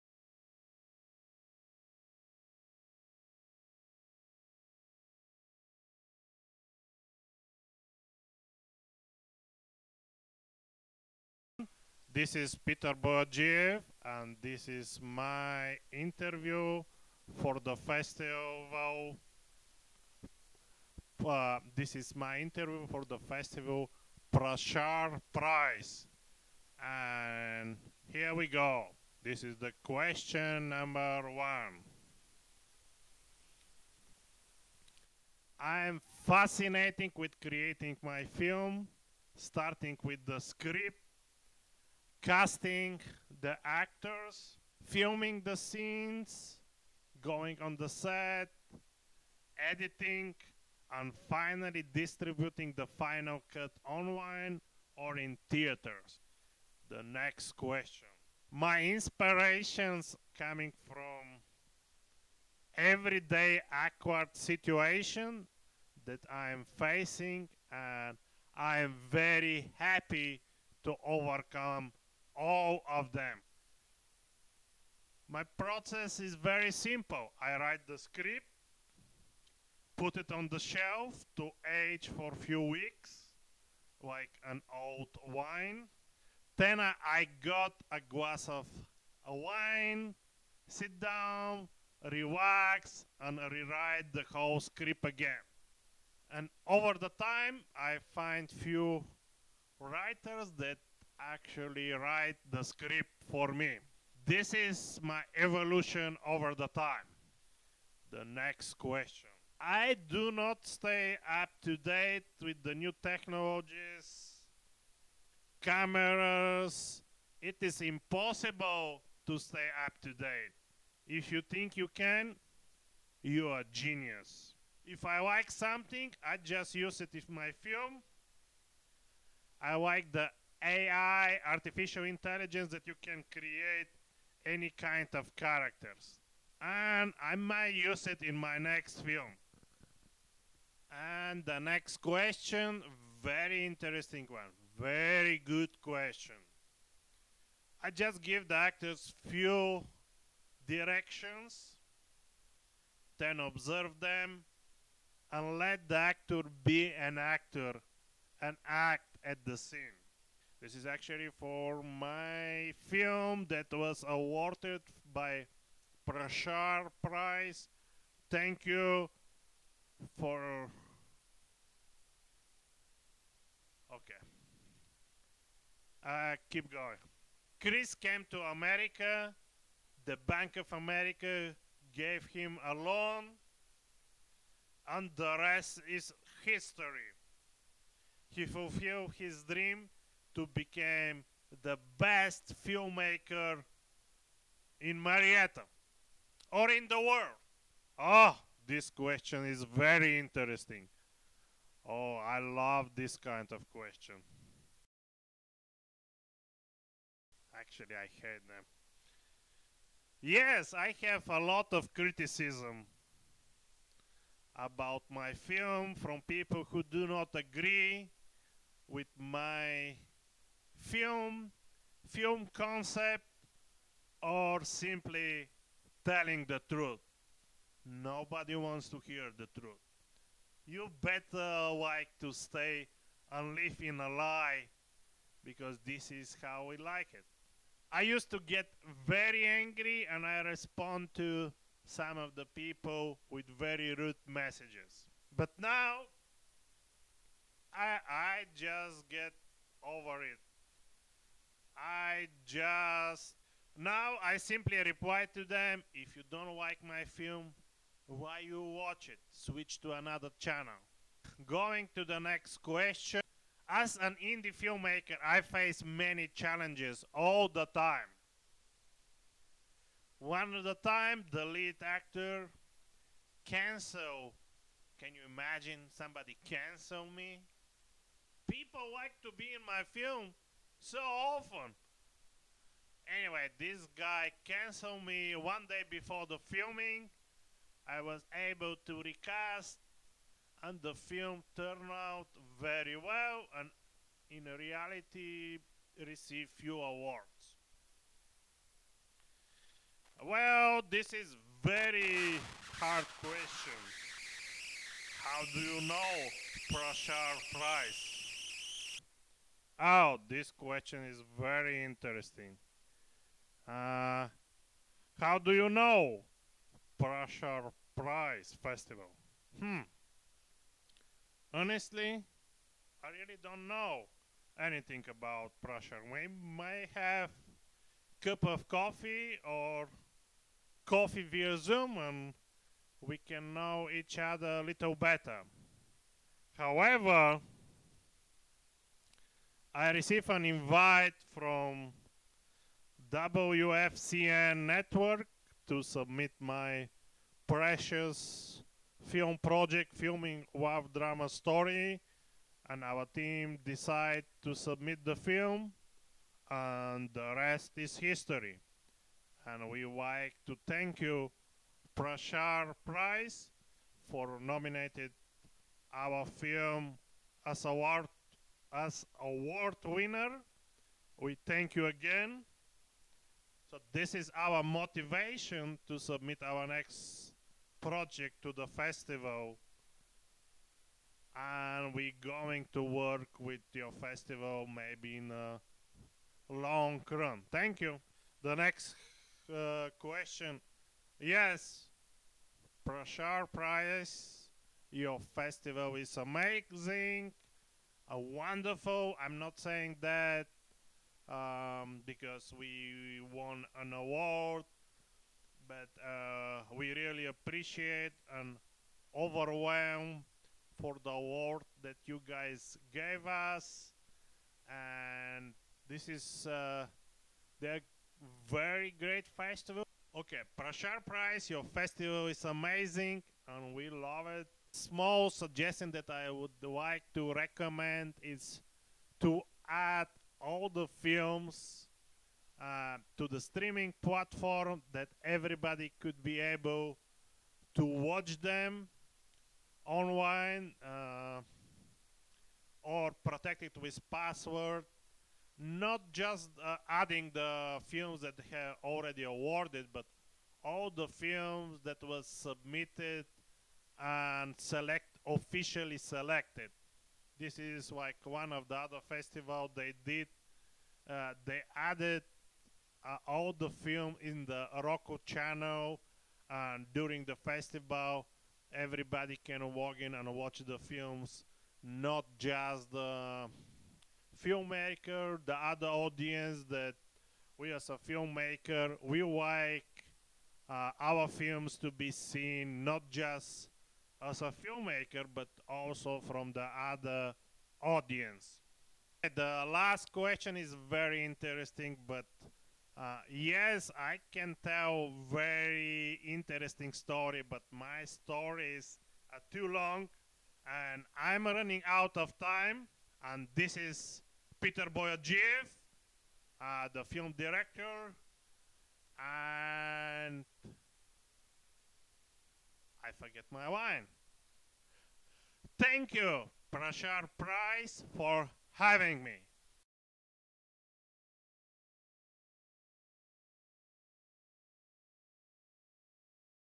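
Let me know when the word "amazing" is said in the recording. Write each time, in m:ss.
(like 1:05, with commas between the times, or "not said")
6:36, 7:02.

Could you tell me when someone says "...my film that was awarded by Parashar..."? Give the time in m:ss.
2:41.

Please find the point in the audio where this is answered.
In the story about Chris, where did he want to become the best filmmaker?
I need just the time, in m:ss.
3:15.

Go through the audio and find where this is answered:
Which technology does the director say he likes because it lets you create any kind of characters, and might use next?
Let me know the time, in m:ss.
2:11.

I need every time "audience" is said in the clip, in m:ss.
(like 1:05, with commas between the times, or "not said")
7:55, 8:07.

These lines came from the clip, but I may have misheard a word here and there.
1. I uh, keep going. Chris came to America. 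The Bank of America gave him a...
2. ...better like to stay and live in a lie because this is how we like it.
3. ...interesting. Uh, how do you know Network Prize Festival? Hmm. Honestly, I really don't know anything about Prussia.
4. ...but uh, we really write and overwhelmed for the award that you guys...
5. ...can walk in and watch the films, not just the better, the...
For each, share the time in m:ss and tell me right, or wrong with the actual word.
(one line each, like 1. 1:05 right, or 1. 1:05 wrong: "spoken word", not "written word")
1. 2:56 right
2. 3:51 right
3. 5:11 wrong: "Prussia", not "Network"
4. 6:45 wrong: "appreciate", not "write"
5. 7:49 wrong: "filmmaker", not "better".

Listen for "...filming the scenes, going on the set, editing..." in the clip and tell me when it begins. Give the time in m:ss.
0:44.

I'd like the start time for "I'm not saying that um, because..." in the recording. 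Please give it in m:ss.
6:39.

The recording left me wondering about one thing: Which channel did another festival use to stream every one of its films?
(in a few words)
Roku.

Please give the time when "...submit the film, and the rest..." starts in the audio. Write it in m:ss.
5:54.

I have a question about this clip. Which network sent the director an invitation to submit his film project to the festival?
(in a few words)
WFCN Network.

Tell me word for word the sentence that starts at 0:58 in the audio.
My inspirations coming from everyday awkward situation that I'm facing and I'm very happy to overcome all of them.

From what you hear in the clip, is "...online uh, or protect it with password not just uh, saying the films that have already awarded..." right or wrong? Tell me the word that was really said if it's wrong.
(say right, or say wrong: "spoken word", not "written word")
wrong: "adding", not "saying".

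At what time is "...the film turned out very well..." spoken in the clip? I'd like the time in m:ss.
4:50.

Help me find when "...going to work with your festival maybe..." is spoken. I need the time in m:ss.
6:22.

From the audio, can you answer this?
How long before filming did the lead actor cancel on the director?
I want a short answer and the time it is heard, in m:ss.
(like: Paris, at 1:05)
one day, at 4:45.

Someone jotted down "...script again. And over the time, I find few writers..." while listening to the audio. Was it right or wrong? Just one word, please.
right.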